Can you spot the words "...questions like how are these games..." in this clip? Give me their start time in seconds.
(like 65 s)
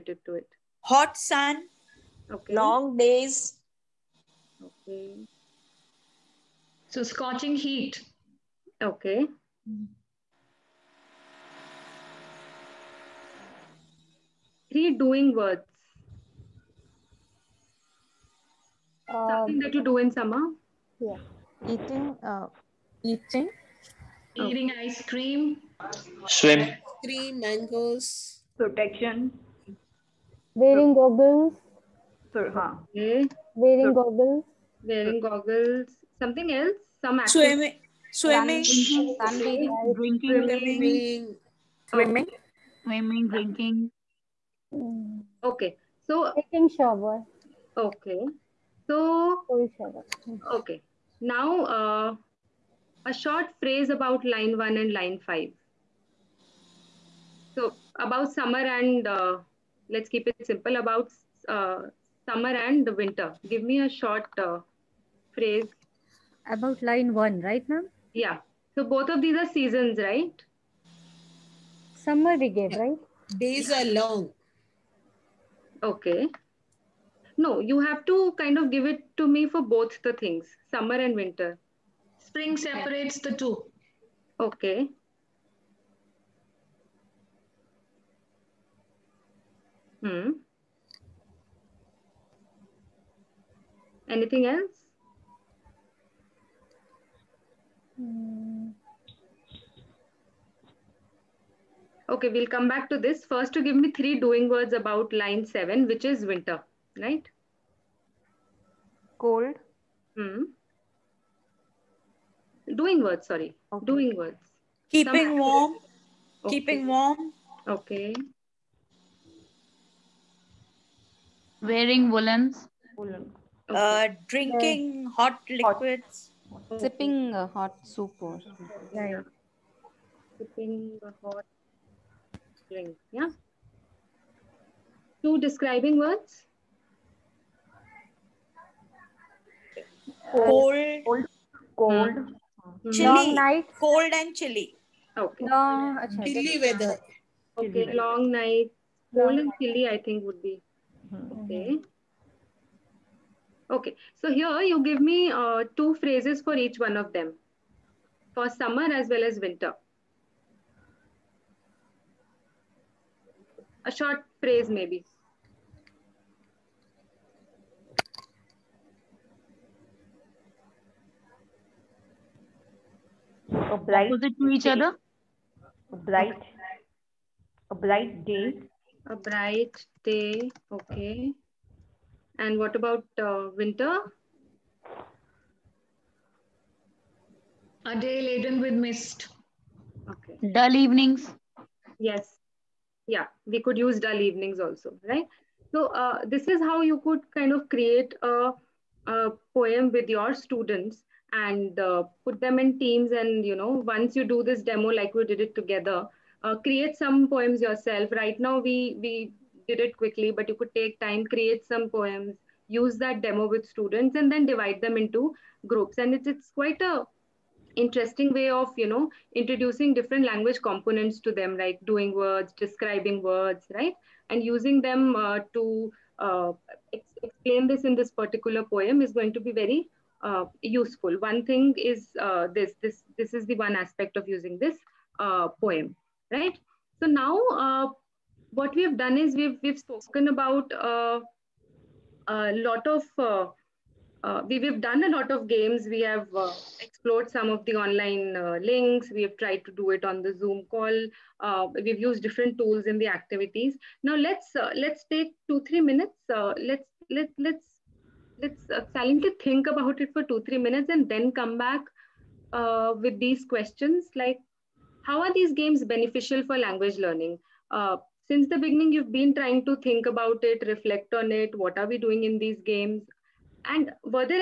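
263 s.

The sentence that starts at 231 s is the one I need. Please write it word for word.
One thing is uh, this this this is the one aspect of using this uh, poem, right.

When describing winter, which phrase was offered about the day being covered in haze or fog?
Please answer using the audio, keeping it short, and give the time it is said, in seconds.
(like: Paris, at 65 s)
A day laden with mist, at 187 s.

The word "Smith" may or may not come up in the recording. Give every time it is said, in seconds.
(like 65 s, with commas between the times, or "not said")
not said.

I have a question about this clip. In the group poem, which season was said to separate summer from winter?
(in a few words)
Spring.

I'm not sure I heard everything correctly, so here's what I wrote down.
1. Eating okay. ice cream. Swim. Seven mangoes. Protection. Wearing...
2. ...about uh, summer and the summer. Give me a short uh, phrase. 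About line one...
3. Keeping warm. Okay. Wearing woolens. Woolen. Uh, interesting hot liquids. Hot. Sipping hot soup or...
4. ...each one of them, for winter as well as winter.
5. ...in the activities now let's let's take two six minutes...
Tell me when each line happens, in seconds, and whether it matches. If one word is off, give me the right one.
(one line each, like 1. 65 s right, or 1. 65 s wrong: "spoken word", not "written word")
1. 24 s wrong: "Three", not "Seven"
2. 60 s wrong: "winter", not "summer"
3. 116 s wrong: "drinking", not "interesting"
4. 156 s wrong: "summer", not "winter"
5. 252 s wrong: "three", not "six".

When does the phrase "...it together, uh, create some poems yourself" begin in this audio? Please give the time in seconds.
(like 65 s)
205 s.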